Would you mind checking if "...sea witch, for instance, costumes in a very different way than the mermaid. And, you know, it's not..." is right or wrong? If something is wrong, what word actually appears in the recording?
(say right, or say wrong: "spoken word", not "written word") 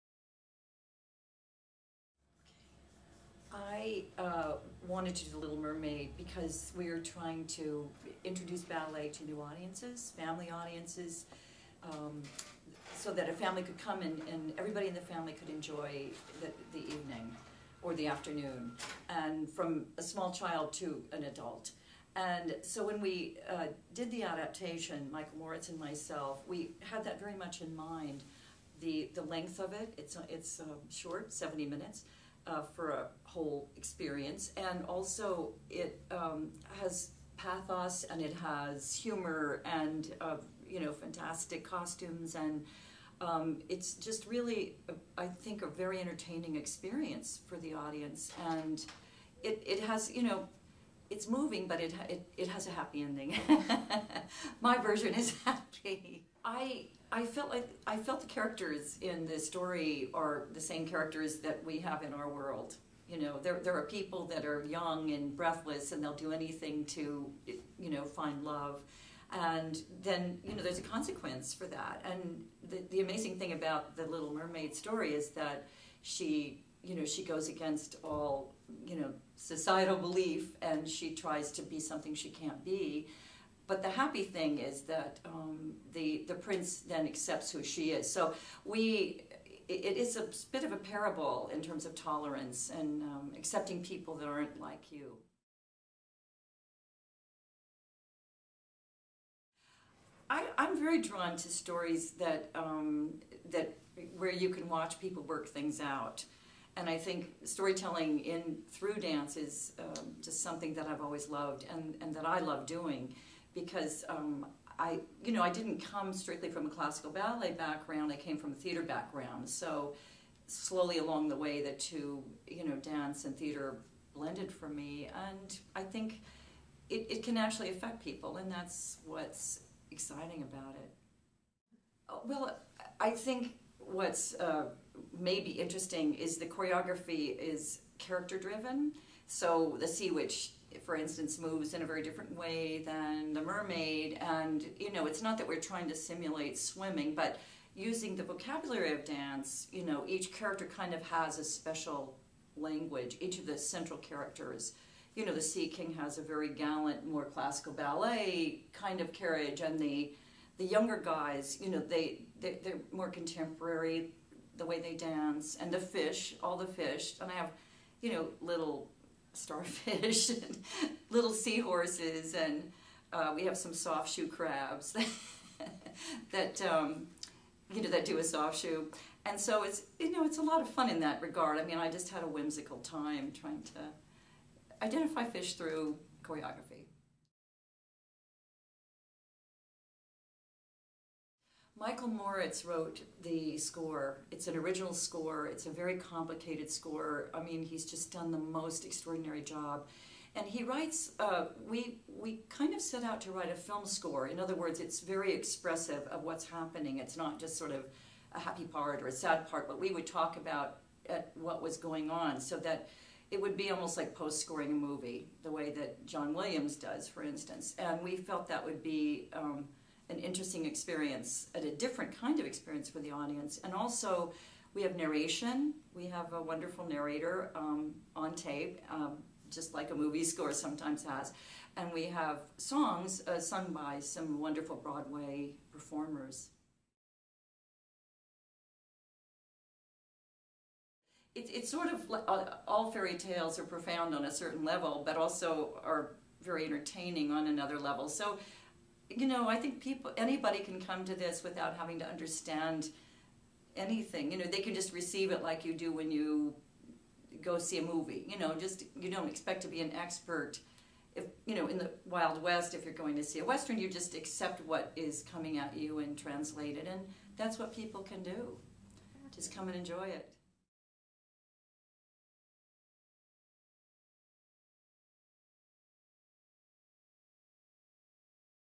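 wrong: "moves", not "costumes".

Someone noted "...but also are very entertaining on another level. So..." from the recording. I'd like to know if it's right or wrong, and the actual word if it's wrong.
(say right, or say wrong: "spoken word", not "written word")
right.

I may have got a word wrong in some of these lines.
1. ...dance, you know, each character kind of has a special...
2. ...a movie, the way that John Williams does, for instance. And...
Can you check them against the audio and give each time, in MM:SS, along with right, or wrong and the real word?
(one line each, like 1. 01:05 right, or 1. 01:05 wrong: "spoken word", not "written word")
1. 02:29 right
2. 03:34 right.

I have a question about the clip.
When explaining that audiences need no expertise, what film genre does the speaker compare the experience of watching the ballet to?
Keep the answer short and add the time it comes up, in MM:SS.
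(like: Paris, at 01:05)
western, at 04:23.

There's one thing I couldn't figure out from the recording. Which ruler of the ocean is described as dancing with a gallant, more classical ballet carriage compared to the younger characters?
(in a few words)
Sea King.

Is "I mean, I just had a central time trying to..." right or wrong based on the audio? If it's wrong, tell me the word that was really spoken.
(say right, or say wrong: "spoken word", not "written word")
wrong: "whimsical", not "central".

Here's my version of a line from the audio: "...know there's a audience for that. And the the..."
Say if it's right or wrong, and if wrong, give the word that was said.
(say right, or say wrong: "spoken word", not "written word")
wrong: "consequence", not "audience".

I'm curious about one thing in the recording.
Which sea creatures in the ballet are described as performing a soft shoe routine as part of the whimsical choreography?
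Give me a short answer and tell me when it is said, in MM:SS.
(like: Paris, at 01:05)
crabs, at 02:54.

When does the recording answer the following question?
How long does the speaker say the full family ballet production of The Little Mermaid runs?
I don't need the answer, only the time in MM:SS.
00:31.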